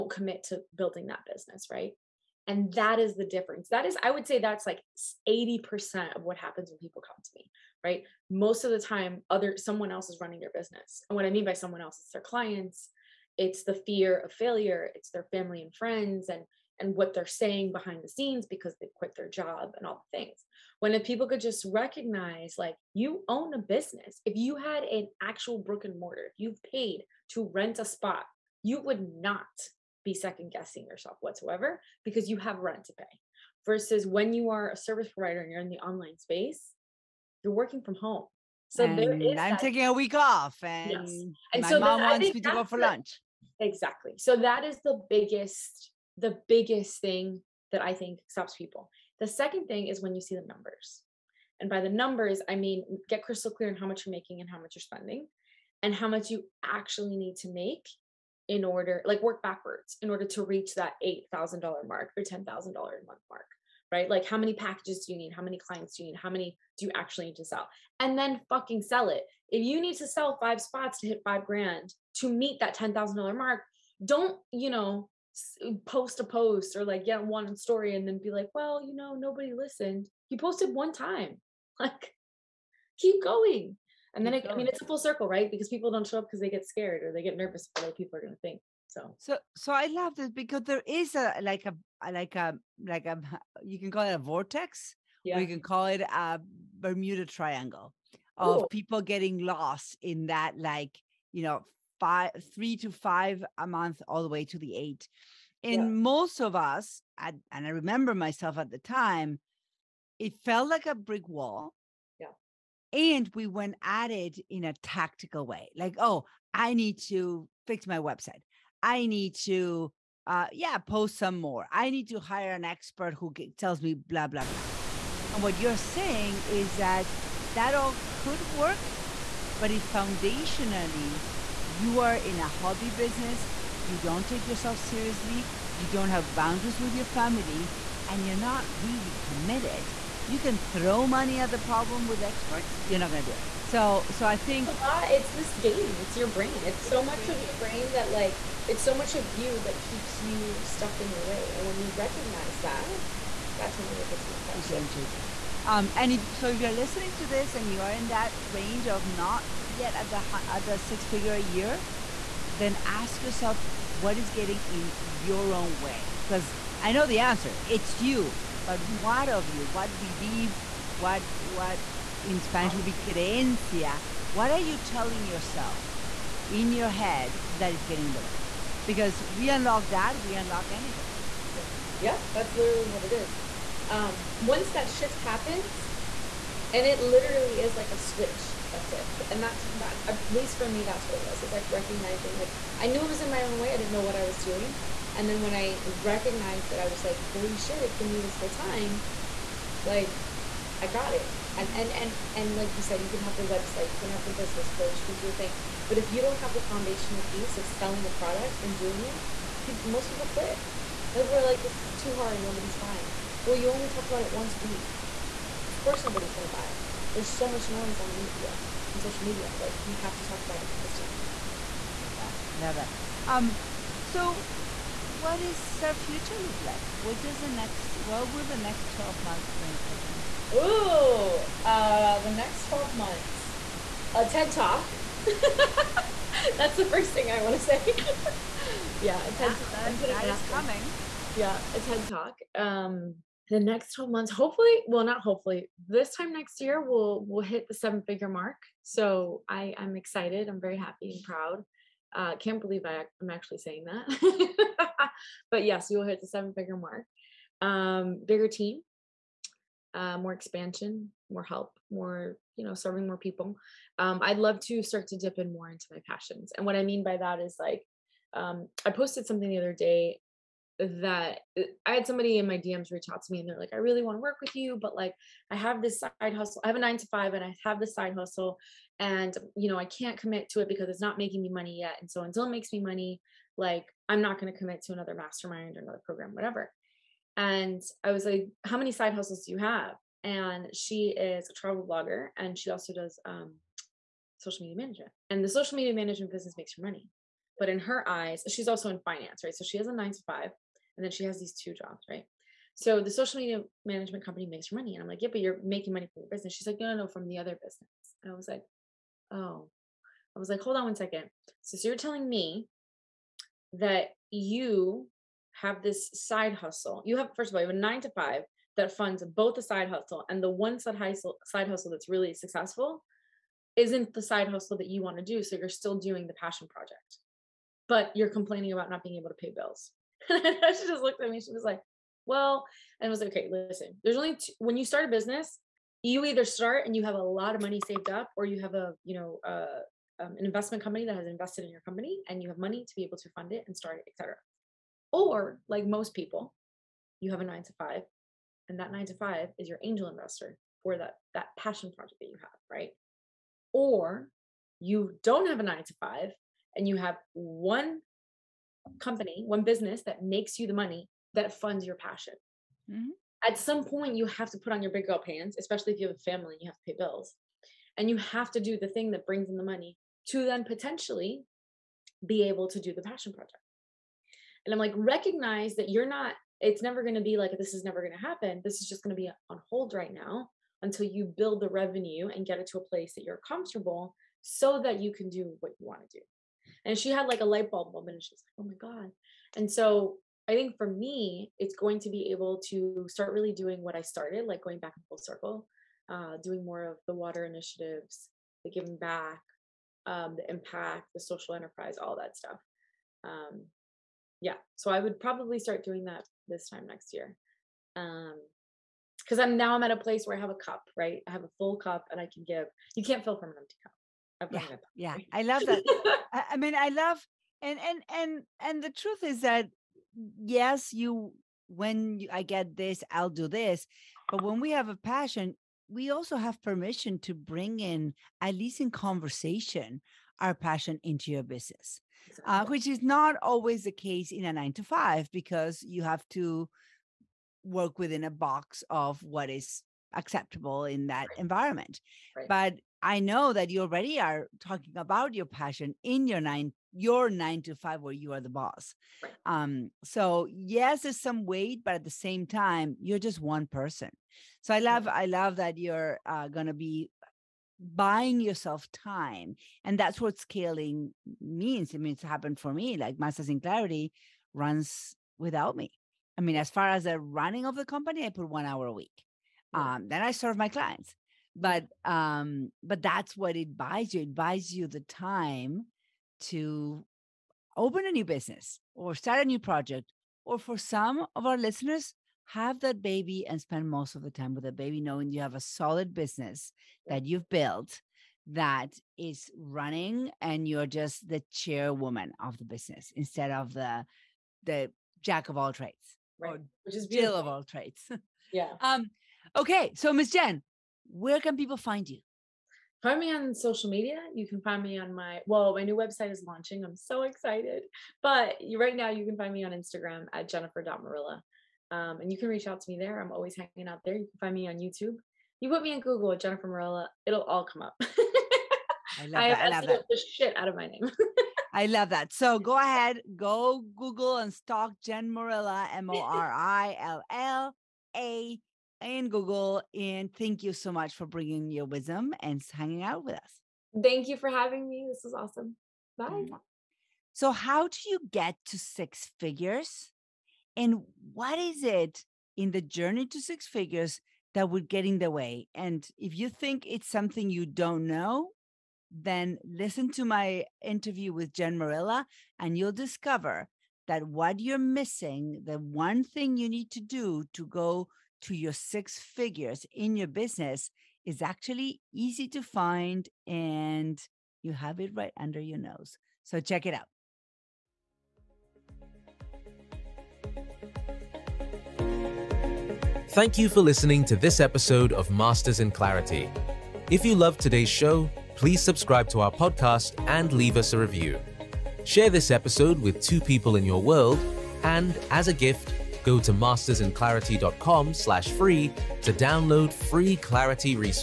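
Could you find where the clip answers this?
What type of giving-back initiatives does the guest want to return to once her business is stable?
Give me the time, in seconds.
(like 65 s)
397 s.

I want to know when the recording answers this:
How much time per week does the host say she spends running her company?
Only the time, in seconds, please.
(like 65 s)
468 s.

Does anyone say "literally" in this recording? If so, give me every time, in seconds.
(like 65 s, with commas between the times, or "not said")
182 s, 187 s.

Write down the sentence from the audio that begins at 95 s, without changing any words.
or you can call it a Bermuda Triangle of Ooh.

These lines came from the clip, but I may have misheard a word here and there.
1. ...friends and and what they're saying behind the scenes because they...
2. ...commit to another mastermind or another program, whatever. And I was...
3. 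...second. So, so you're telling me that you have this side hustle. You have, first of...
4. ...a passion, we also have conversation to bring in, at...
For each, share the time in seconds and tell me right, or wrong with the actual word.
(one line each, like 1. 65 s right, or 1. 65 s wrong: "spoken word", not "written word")
1. 15 s right
2. 284 s right
3. 310 s right
4. 424 s wrong: "permission", not "conversation".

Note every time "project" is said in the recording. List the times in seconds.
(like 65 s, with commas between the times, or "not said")
326 s, 351 s, 373 s, 479 s.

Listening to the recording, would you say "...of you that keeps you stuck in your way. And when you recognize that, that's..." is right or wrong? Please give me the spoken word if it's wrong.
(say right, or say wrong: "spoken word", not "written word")
right.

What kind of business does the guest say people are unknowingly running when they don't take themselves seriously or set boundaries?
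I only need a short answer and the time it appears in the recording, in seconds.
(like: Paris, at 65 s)
hobby business, at 132 s.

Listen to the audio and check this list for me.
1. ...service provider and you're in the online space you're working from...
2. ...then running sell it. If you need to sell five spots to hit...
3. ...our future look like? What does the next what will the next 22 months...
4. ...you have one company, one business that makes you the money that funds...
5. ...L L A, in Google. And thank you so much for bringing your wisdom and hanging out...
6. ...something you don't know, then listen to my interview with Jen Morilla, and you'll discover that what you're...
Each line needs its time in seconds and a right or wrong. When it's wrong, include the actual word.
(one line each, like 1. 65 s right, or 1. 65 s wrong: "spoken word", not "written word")
1. 34 s right
2. 68 s wrong: "fucking", not "running"
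3. 225 s wrong: "12", not "22"
4. 356 s right
5. 526 s right
6. 547 s right.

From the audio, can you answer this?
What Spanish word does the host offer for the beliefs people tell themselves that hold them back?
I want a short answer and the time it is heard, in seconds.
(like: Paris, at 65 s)
creencia, at 173 s.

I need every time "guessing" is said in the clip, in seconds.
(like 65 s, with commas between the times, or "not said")
30 s.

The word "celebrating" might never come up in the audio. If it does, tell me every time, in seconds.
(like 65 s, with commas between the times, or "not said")
not said.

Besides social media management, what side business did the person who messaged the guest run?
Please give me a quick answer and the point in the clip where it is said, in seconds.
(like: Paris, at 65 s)
travel blogger, at 291 s.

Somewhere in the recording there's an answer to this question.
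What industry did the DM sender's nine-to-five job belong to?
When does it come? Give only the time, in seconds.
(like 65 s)
299 s.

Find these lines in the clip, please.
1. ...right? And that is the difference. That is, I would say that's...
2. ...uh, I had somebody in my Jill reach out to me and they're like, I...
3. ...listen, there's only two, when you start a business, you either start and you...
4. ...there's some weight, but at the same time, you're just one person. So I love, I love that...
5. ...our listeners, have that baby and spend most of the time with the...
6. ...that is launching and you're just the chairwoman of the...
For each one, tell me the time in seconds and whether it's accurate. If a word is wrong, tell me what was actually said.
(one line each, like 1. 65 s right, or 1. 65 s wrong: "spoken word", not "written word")
1. 1 s right
2. 271 s wrong: "DMs", not "Jill"
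3. 333 s right
4. 451 s right
5. 481 s right
6. 488 s wrong: "running", not "launching".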